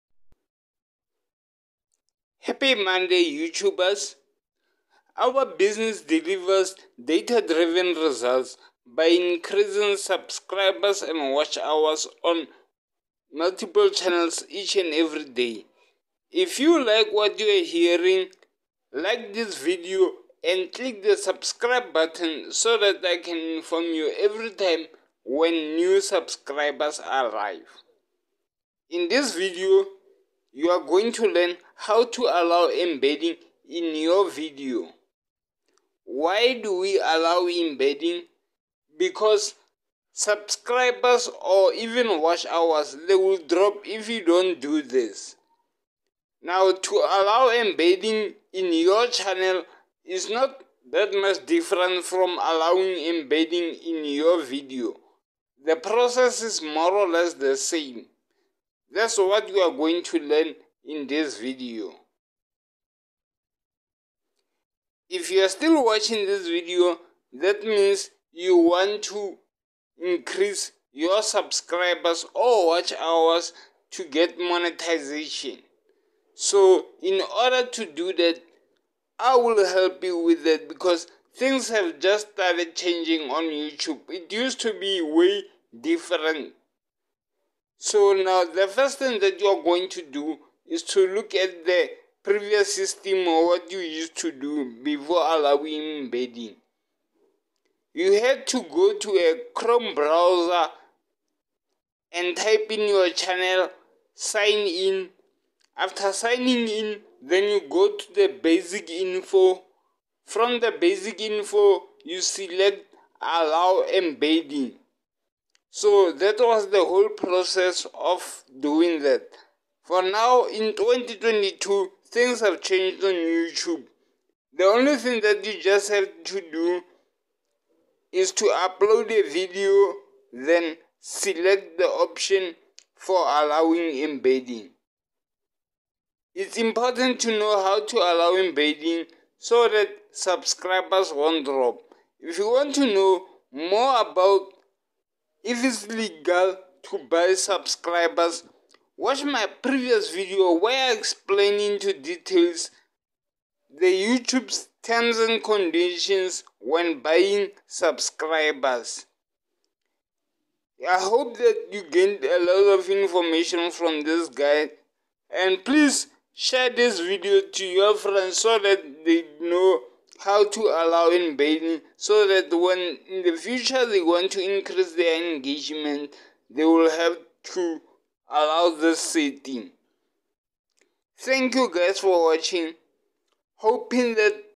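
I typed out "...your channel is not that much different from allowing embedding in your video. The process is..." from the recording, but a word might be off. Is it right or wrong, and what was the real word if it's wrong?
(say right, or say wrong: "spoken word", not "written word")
right.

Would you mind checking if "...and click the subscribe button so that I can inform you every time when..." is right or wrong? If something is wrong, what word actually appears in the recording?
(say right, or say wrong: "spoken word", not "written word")
right.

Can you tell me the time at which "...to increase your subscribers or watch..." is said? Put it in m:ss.
1:09.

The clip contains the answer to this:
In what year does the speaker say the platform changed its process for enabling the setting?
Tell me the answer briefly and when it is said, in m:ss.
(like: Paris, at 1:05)
2022, at 2:00.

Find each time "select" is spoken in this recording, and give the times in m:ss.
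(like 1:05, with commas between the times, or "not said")
1:52, 2:10.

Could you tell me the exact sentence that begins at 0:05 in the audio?
Our business delivers data driven results by increasing subscribers and watch hours on multiple channels each and every day.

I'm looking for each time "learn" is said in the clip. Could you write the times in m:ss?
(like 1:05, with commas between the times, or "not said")
0:31, 1:00.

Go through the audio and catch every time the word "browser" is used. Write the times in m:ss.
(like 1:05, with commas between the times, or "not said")
1:39.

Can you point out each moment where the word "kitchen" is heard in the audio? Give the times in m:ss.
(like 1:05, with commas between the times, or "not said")
not said.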